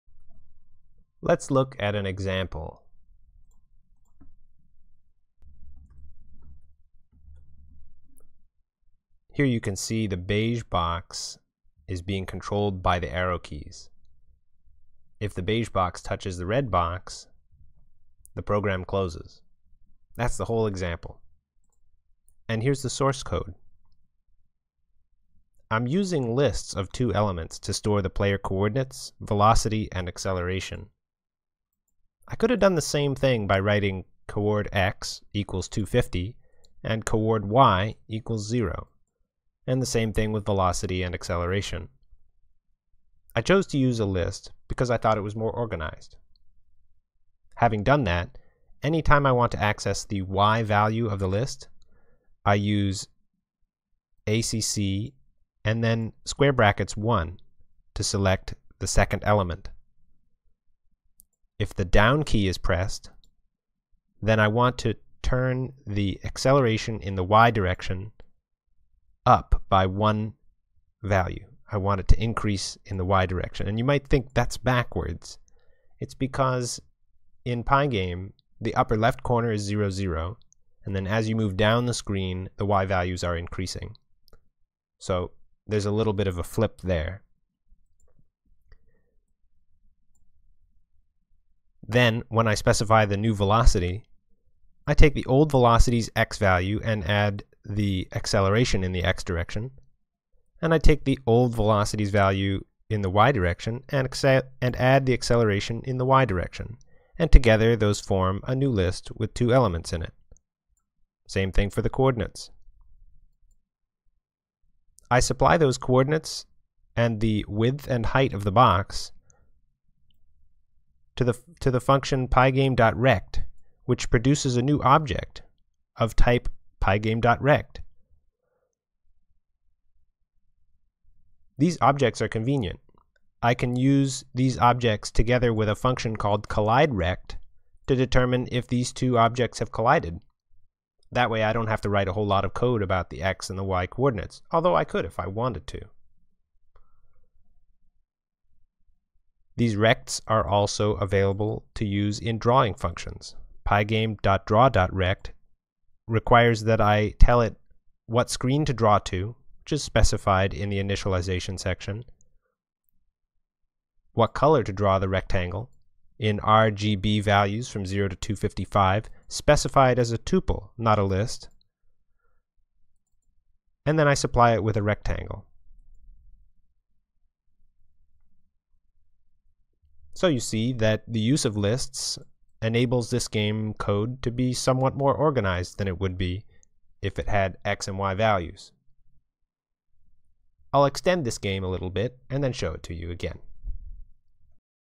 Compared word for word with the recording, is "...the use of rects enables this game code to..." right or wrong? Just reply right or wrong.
wrong.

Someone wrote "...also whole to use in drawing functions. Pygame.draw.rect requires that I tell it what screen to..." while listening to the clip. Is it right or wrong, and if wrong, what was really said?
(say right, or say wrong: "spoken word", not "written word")
wrong: "available", not "whole".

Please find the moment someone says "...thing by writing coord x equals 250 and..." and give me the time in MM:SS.
00:33.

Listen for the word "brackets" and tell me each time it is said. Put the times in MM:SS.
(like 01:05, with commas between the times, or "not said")
00:56.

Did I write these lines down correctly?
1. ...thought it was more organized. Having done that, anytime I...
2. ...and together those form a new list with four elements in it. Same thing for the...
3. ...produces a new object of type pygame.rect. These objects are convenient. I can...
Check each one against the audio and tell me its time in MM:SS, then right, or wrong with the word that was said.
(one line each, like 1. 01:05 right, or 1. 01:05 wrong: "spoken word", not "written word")
1. 00:44 right
2. 01:47 wrong: "two", not "four"
3. 02:04 right.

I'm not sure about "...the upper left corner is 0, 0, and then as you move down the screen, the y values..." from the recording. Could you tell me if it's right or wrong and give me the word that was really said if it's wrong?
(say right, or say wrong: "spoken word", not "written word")
right.